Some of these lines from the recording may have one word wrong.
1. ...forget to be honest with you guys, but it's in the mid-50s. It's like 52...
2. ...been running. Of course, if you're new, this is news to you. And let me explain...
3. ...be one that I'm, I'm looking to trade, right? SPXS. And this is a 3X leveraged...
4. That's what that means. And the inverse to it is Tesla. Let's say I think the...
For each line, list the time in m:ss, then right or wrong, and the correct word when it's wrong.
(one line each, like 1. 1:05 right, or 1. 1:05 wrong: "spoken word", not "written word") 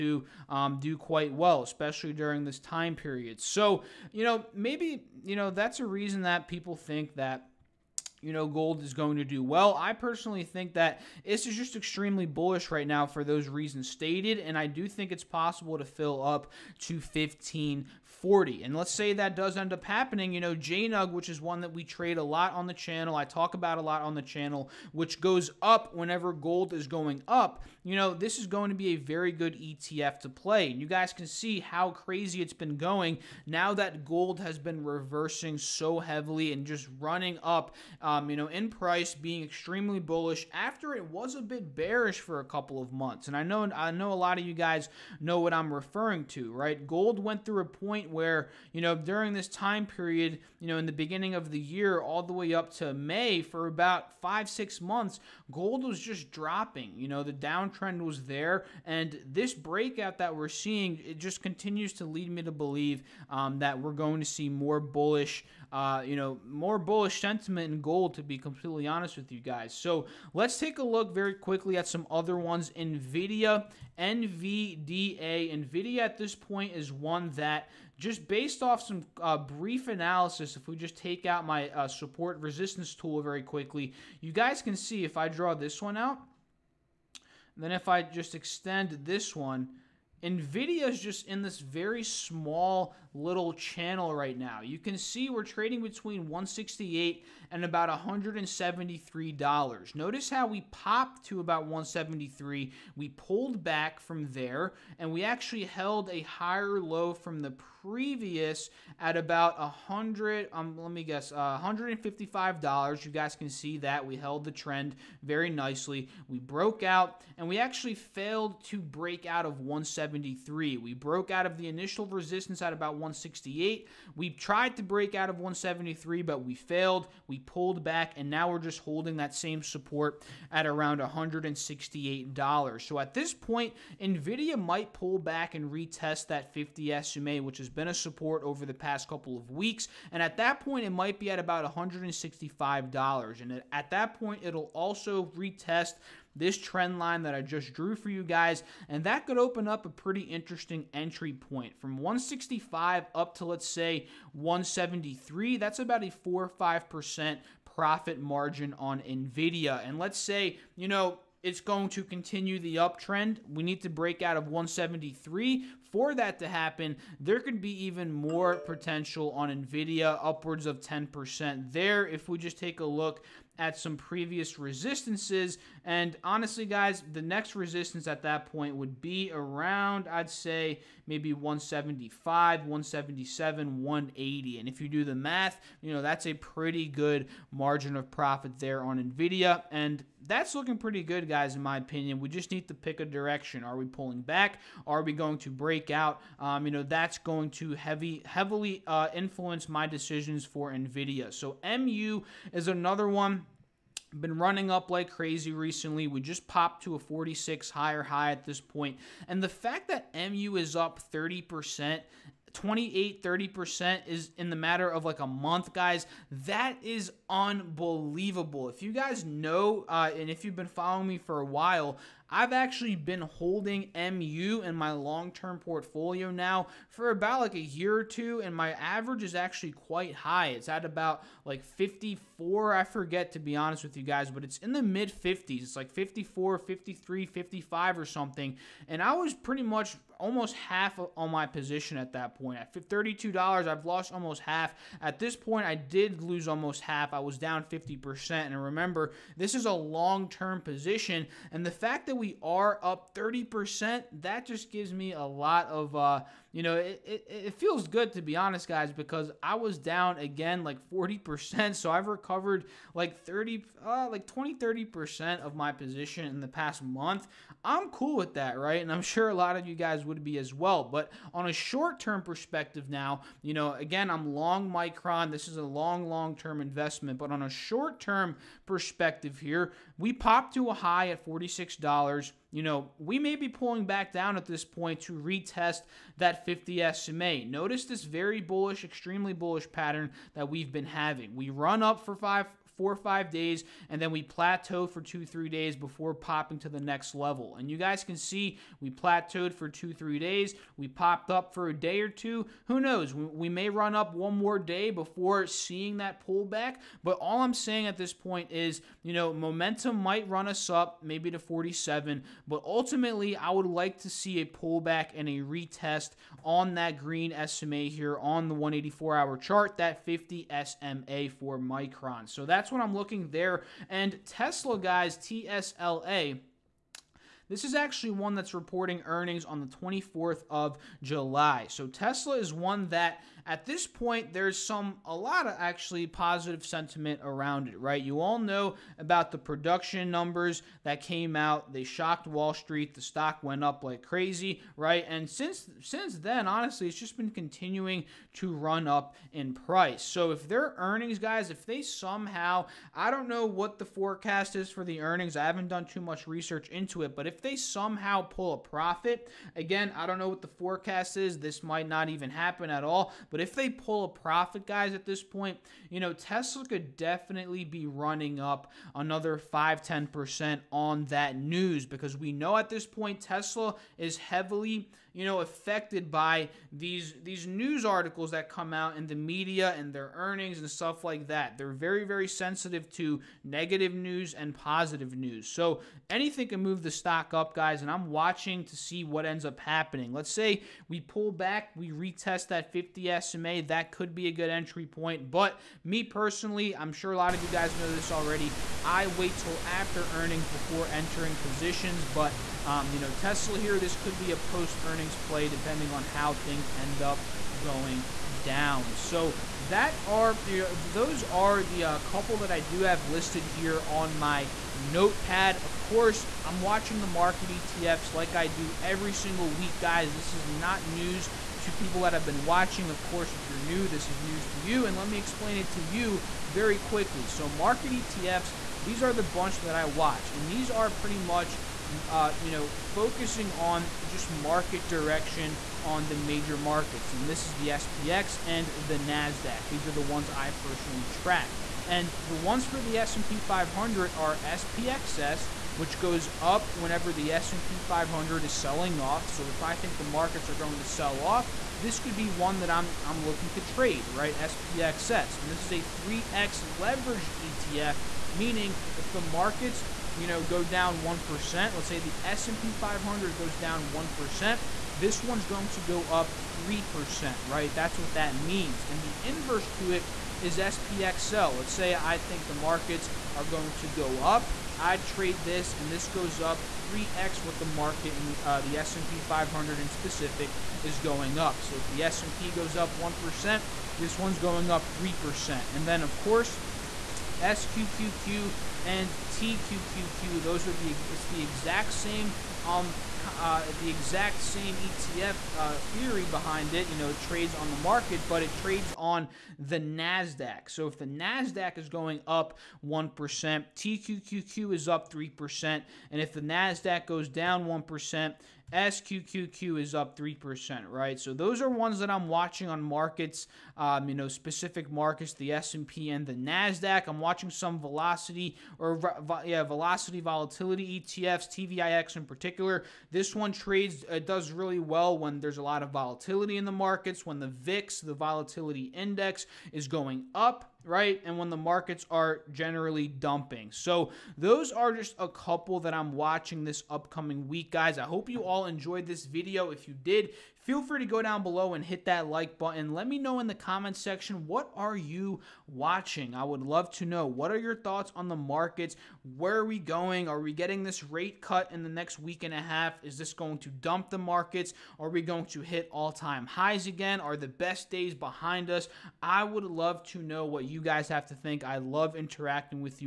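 1. 3:52 wrong: "54", not "52"
2. 7:02 wrong: "watching", not "running"
3. 7:32 right
4. 7:47 wrong: "SPXL", not "Tesla".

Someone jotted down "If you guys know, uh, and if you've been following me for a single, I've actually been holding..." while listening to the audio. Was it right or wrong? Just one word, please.
wrong.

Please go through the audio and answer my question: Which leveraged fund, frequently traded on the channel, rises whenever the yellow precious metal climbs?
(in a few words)
JNUG.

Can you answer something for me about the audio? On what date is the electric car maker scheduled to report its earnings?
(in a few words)
24th of July.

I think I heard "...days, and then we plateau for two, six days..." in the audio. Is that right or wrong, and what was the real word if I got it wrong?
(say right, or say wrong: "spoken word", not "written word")
wrong: "three", not "six".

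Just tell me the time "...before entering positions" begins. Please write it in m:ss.
6:40.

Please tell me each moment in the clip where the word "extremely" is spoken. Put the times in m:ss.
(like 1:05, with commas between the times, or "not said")
0:11, 0:39, 4:48.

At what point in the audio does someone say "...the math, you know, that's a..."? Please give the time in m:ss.
3:05.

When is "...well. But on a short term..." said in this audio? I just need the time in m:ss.
4:30.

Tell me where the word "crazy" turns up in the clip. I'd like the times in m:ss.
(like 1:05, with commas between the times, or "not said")
0:31, 3:25, 5:44.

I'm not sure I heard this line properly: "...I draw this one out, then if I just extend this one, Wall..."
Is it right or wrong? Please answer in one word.
wrong.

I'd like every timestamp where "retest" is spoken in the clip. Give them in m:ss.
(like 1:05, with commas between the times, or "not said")
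2:15, 2:25, 4:45, 5:15, 6:31.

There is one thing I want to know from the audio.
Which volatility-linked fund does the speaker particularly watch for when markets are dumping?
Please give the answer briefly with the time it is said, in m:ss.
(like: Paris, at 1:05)
TVIX, at 8:41.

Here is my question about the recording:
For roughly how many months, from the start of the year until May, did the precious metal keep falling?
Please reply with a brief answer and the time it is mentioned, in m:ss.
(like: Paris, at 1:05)
5 or 6, at 0:54.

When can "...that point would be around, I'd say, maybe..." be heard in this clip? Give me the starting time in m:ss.
2:58.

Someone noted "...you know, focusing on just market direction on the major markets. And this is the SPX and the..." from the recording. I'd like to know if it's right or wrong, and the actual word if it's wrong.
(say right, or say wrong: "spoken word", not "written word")
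right.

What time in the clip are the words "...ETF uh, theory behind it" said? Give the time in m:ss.
8:14.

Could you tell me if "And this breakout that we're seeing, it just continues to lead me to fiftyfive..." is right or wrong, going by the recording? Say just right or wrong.
wrong.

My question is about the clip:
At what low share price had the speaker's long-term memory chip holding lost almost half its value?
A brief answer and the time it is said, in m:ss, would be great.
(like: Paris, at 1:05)
$32, at 4:02.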